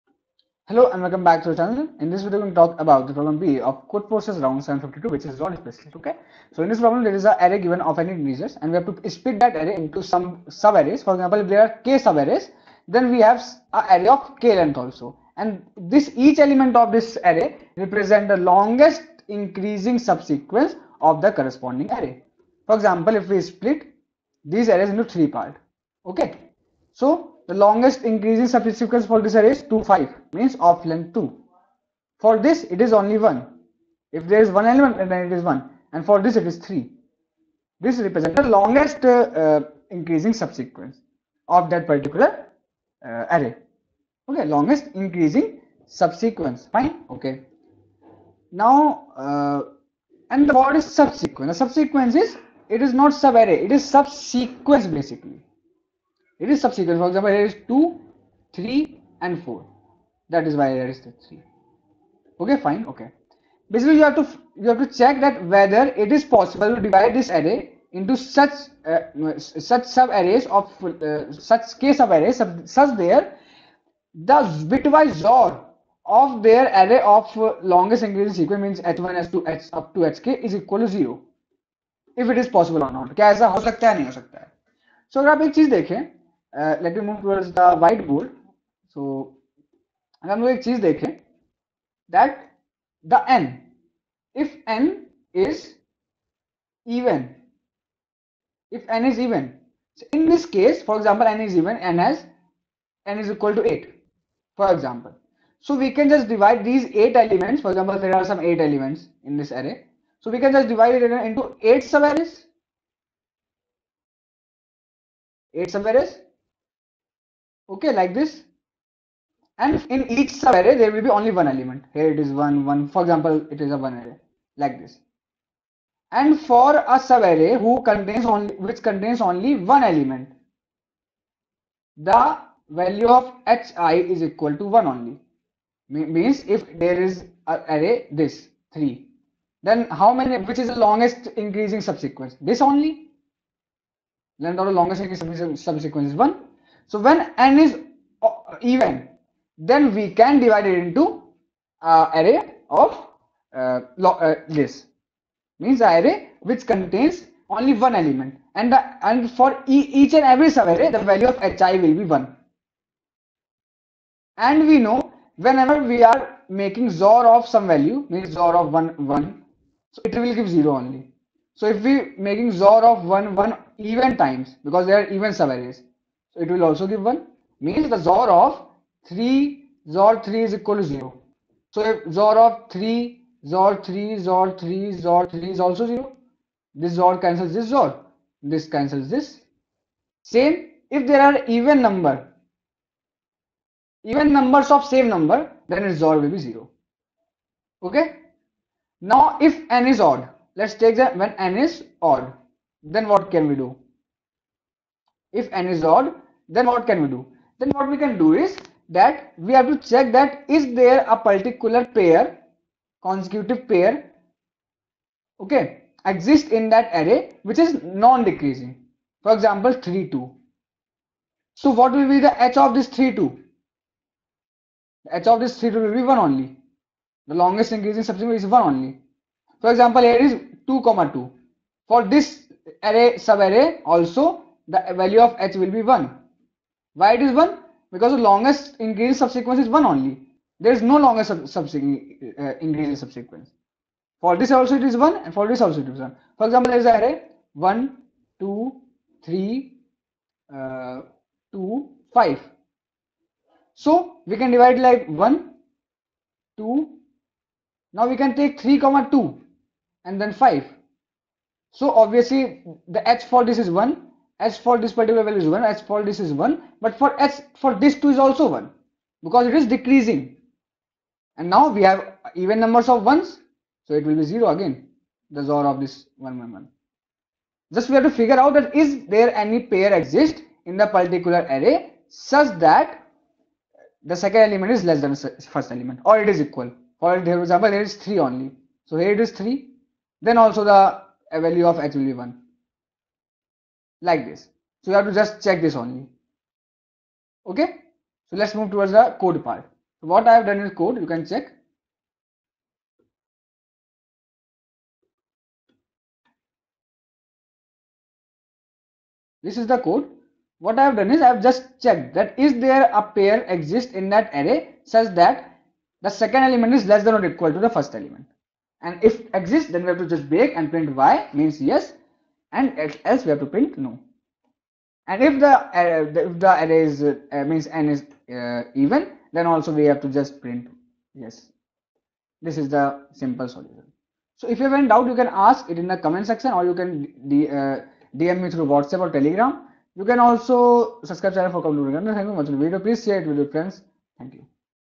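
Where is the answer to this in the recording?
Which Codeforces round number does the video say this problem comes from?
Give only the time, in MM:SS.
00:04.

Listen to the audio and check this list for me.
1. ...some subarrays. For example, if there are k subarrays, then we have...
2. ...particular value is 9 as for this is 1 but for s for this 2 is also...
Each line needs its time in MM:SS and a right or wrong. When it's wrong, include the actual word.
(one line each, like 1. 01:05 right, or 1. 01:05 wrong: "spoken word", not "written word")
1. 00:10 right
2. 04:24 wrong: "1", not "9".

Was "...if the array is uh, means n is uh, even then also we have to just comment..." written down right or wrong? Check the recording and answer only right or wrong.
wrong.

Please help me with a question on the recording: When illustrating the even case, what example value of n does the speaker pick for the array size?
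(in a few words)
8.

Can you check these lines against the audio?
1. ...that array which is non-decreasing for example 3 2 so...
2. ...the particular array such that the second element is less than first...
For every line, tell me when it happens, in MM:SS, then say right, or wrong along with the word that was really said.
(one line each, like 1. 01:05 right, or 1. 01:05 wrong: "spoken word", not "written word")
1. 03:36 right
2. 04:40 right.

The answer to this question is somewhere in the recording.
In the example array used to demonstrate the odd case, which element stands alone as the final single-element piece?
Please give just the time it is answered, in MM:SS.
04:20.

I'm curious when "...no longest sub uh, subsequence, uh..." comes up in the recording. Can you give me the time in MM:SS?
04:00.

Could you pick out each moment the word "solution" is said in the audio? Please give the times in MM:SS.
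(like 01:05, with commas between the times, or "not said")
05:33.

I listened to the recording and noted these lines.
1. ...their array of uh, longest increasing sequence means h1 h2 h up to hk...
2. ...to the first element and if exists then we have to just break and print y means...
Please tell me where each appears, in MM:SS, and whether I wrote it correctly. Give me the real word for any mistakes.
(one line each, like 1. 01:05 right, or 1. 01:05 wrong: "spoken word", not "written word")
1. 01:16 right
2. 05:17 right.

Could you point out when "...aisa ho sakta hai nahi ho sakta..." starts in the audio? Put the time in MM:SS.
01:23.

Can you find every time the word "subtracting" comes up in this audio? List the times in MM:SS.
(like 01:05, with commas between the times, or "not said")
not said.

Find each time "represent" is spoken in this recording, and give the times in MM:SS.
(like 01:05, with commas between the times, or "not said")
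00:17, 00:37.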